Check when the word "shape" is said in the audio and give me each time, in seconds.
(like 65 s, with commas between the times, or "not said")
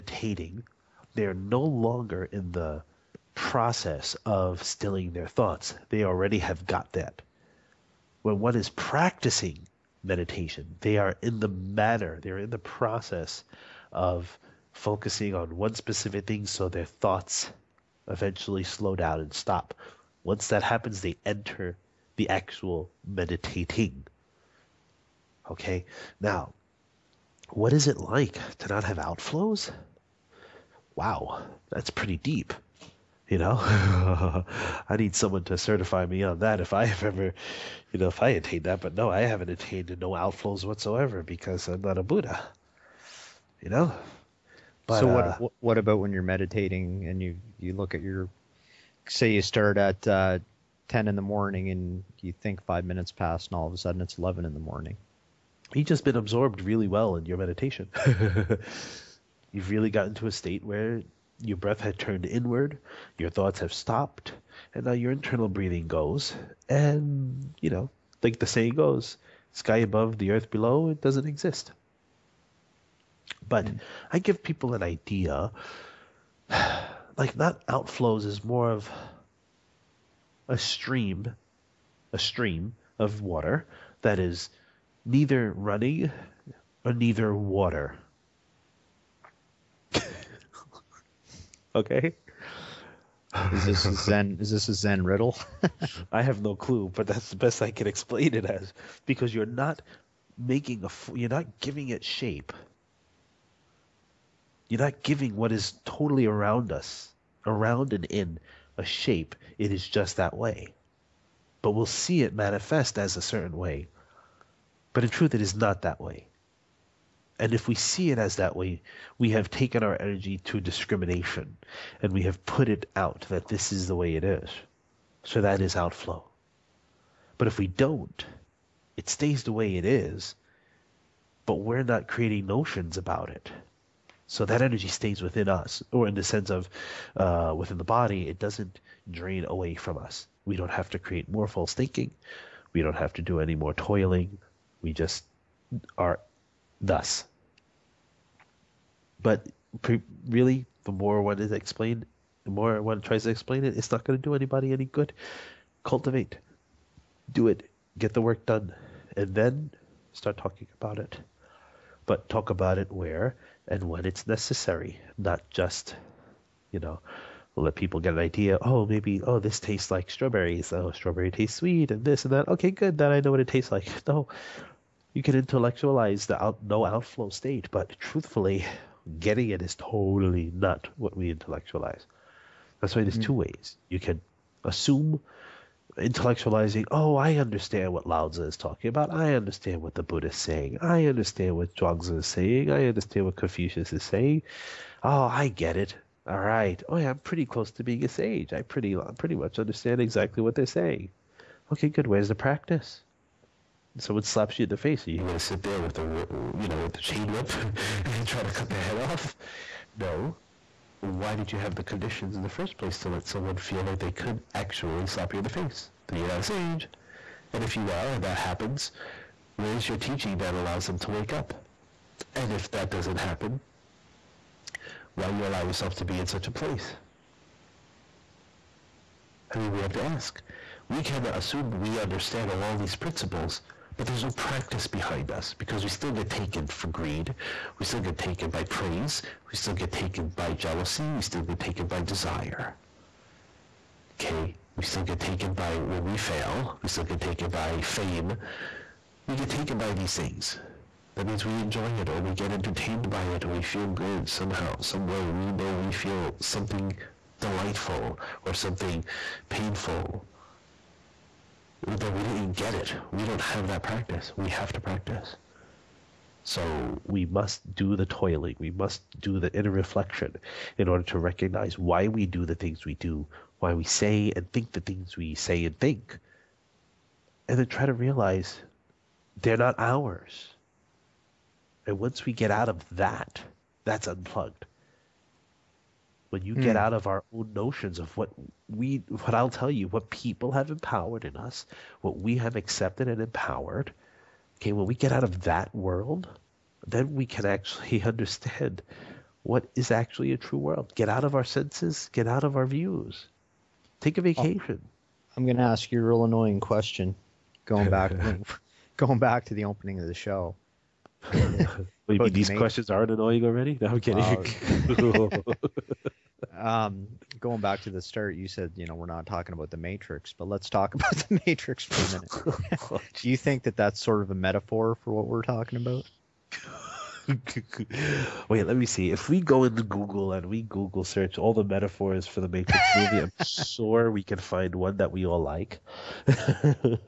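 102 s, 108 s.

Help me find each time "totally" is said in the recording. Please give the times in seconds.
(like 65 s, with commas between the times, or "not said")
105 s, 179 s.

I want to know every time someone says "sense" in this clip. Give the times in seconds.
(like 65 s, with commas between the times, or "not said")
136 s, 301 s.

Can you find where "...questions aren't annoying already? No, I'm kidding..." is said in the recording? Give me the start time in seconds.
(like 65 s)
312 s.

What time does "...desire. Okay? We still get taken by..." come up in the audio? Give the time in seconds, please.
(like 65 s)
242 s.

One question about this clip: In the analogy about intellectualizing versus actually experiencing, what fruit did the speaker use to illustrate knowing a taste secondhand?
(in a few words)
strawberries.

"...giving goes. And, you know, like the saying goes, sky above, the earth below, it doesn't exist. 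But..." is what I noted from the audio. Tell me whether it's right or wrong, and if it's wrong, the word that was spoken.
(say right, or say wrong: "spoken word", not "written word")
wrong: "breathing", not "giving".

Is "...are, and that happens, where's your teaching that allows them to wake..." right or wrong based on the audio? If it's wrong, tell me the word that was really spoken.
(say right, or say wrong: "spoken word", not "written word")
right.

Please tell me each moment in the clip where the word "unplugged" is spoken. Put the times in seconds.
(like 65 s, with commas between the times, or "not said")
284 s.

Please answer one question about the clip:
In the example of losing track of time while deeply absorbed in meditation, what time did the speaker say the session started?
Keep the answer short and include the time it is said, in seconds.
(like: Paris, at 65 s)
10 in the morning, at 50 s.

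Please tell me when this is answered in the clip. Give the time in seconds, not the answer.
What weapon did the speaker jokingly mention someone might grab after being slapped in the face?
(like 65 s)
207 s.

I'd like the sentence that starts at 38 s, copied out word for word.
But no, I haven't attained no outflows whatsoever because I'm not a Buddha.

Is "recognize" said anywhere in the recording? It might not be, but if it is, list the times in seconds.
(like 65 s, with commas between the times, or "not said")
271 s.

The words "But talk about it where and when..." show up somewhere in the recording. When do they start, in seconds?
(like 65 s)
162 s.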